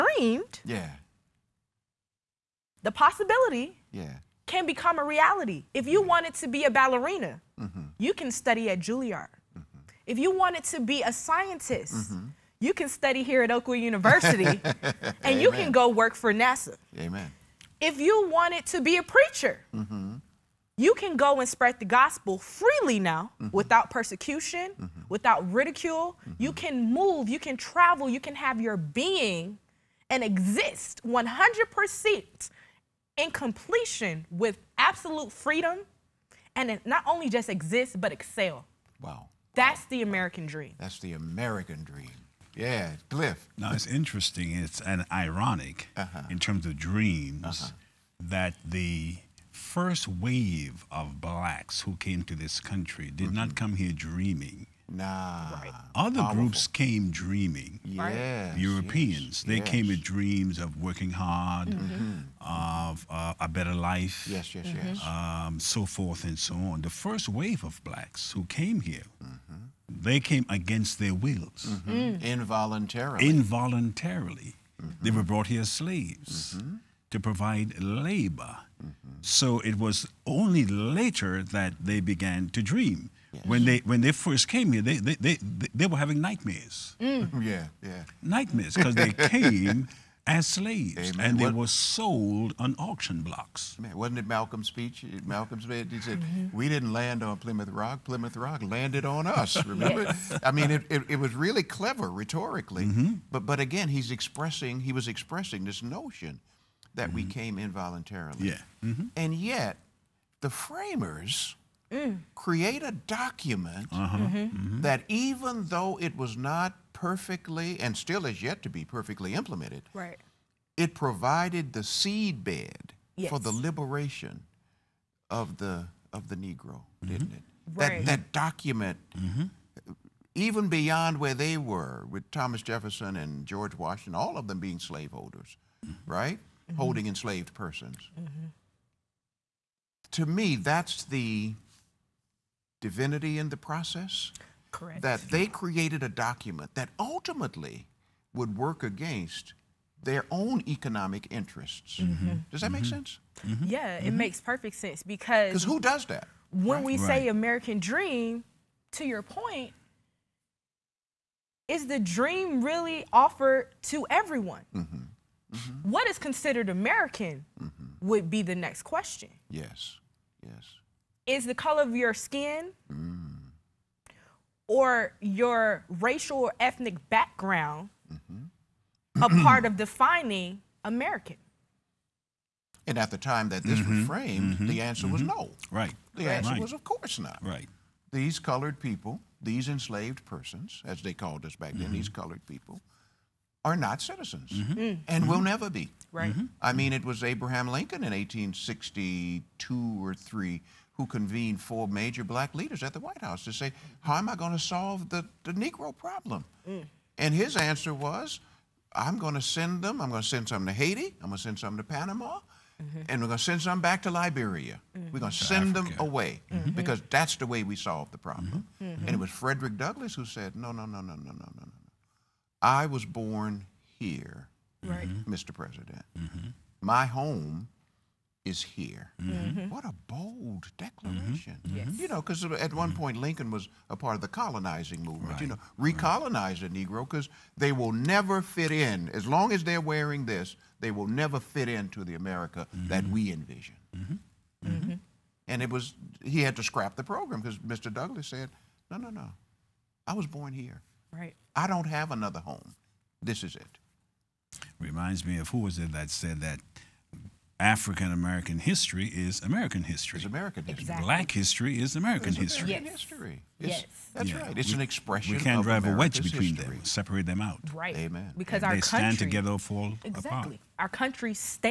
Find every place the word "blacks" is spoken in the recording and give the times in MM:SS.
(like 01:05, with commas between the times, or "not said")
00:51, 01:07, 03:22, 04:21.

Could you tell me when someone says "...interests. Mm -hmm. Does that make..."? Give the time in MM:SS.
02:31.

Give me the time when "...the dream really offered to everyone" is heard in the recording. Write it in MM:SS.
02:41.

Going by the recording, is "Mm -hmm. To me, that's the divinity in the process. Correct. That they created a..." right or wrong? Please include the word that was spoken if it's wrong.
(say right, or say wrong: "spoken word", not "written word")
right.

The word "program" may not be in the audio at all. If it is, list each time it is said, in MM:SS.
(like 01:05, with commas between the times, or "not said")
04:07.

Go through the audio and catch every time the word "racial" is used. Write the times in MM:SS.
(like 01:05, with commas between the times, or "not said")
02:55.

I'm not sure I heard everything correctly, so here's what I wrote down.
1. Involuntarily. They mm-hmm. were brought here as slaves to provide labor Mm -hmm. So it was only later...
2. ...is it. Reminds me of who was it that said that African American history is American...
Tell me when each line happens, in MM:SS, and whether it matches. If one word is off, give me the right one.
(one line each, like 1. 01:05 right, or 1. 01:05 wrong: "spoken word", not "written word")
1. 01:13 right
2. 04:13 right.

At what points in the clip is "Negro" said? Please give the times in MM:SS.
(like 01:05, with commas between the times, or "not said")
02:06, 03:25, 03:56.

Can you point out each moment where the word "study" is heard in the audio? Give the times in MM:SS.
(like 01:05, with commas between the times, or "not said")
00:08, 00:12.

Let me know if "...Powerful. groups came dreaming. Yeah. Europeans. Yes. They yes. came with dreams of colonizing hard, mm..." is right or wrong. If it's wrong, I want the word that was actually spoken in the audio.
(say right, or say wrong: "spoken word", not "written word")
wrong: "working", not "colonizing".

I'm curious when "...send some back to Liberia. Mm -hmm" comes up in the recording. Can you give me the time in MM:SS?
03:33.